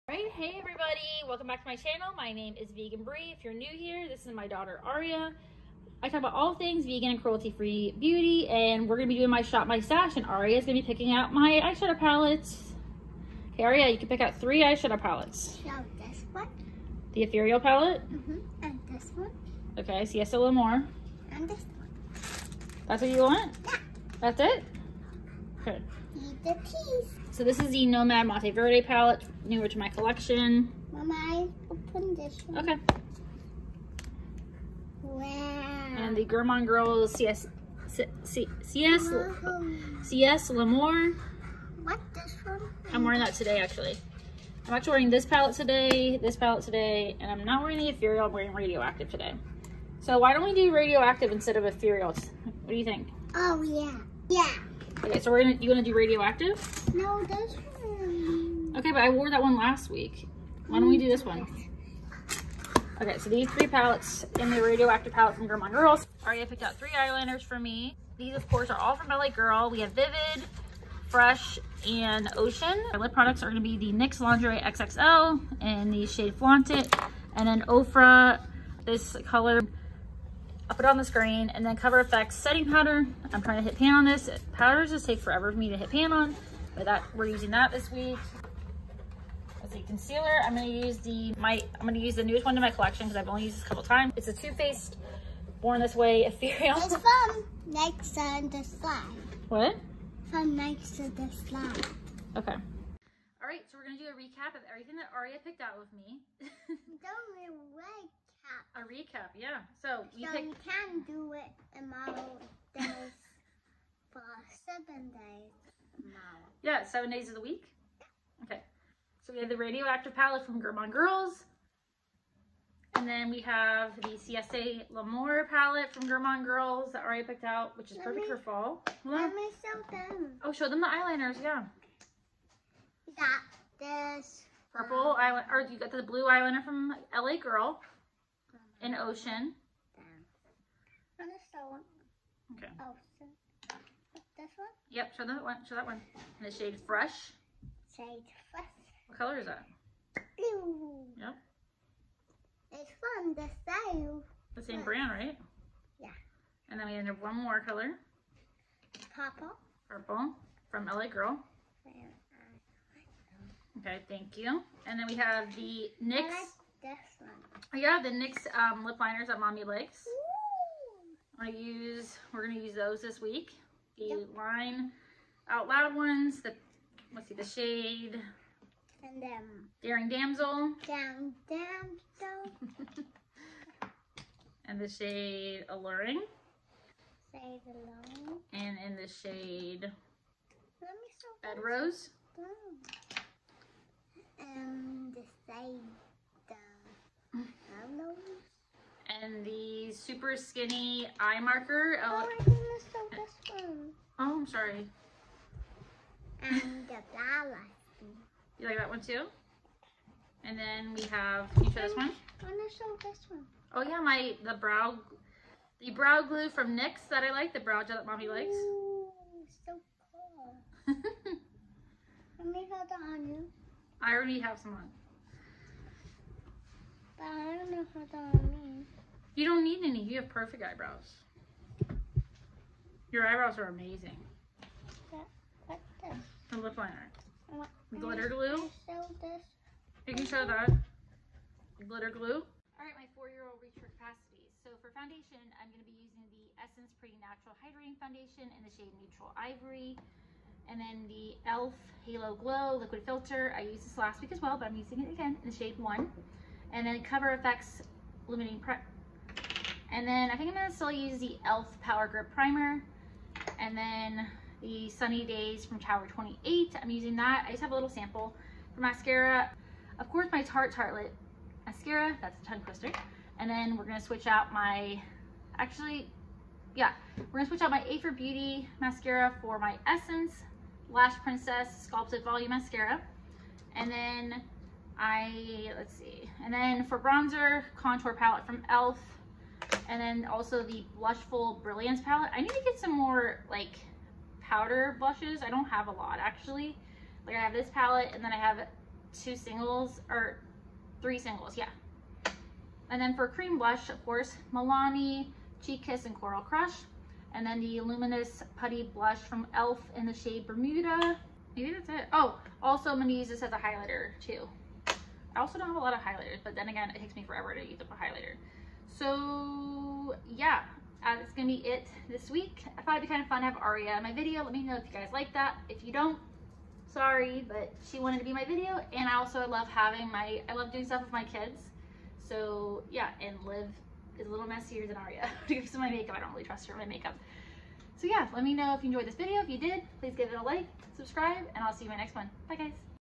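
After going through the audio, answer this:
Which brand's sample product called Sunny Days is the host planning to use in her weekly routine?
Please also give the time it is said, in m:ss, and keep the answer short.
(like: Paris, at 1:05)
Tower 28, at 4:25.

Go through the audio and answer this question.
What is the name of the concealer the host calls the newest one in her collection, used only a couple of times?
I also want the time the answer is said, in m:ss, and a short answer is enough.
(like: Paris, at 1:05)
Too Faced Born This Way Ethereal, at 1:34.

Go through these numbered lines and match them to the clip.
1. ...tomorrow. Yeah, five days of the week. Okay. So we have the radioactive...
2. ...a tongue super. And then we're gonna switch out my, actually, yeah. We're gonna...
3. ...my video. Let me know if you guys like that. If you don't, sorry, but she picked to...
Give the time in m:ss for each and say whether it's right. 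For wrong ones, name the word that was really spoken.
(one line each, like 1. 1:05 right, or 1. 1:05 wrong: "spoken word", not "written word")
1. 1:55 wrong: "seven", not "five"
2. 4:32 wrong: "twister", not "super"
3. 5:24 wrong: "wanted", not "picked".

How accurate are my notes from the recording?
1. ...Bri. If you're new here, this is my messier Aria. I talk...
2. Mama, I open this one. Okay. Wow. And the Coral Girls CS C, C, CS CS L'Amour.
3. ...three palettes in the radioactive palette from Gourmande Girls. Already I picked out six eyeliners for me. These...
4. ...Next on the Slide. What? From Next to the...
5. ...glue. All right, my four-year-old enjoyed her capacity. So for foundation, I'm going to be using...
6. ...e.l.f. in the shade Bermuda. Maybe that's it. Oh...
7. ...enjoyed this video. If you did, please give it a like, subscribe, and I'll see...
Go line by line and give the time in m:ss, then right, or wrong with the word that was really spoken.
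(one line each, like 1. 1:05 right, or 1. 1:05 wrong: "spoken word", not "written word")
1. 0:03 wrong: "daughter", not "messier"
2. 0:30 wrong: "Gourmande", not "Coral"
3. 1:03 wrong: "three", not "six"
4. 1:37 right
5. 4:02 wrong: "reached", not "enjoyed"
6. 5:09 right
7. 5:38 right.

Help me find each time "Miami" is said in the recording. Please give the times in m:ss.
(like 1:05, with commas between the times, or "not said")
not said.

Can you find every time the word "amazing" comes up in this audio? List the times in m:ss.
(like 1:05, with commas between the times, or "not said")
3:53.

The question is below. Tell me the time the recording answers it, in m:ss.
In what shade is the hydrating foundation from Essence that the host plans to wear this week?
4:08.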